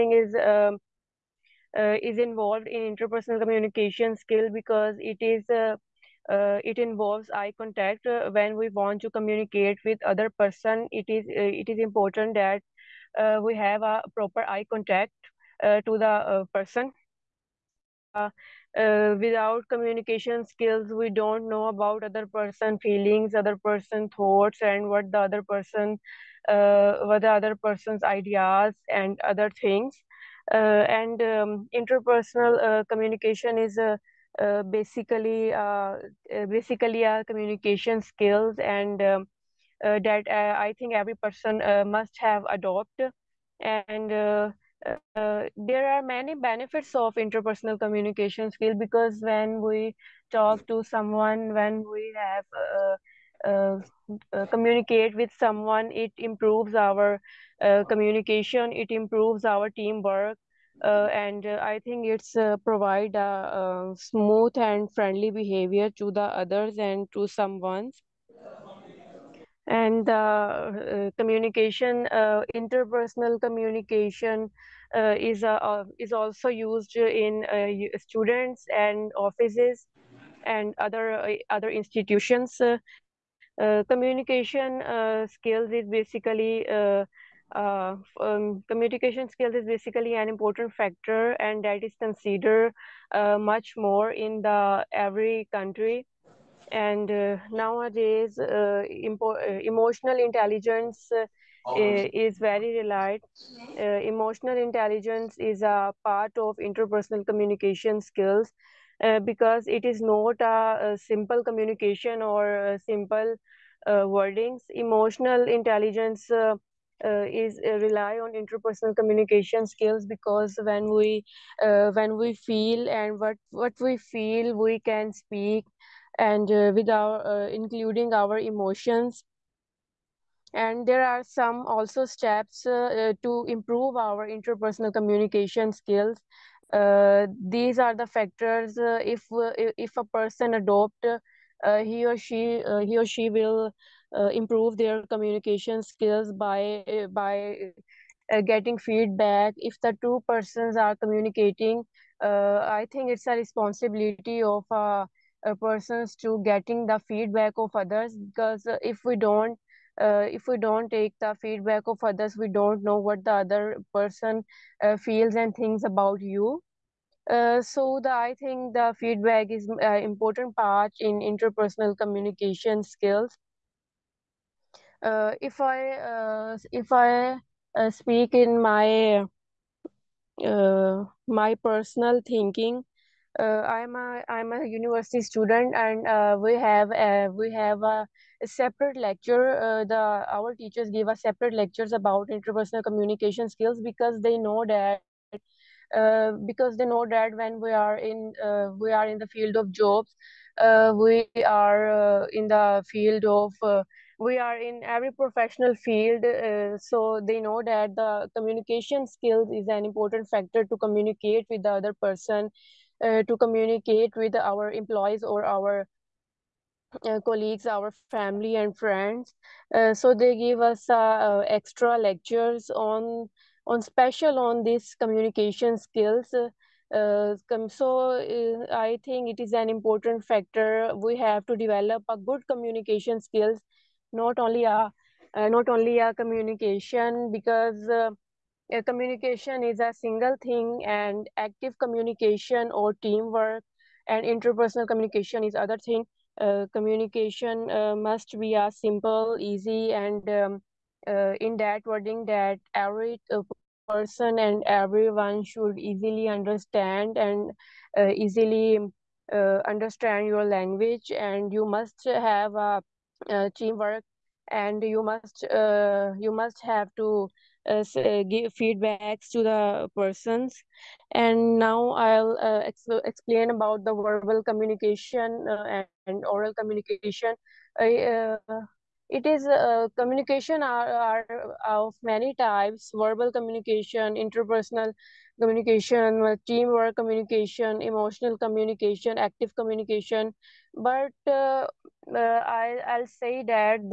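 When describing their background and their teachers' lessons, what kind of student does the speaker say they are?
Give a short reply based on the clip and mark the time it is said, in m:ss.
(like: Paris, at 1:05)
University student, at 3:04.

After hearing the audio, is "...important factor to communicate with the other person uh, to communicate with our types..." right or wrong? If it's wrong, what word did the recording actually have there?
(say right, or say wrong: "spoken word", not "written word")
wrong: "employees", not "types".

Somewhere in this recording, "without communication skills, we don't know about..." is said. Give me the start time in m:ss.
0:19.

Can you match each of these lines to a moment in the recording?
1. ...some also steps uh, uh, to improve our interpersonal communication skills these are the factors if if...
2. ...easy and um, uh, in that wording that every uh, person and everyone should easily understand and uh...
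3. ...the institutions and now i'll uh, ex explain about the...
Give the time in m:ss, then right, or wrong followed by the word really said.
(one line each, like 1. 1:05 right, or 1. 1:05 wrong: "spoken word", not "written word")
1. 2:11 right
2. 4:09 right
3. 4:29 wrong: "persons", not "institutions".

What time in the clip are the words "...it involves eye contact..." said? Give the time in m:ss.
0:06.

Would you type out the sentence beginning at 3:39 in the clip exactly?
Uh, so they give us uh, uh extra lectures on on special on these communication skills.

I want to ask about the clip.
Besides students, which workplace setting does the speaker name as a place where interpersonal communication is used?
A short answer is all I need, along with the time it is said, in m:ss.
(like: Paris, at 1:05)
Offices, at 1:19.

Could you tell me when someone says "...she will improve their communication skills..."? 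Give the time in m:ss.
2:23.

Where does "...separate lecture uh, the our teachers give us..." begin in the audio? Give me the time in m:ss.
3:08.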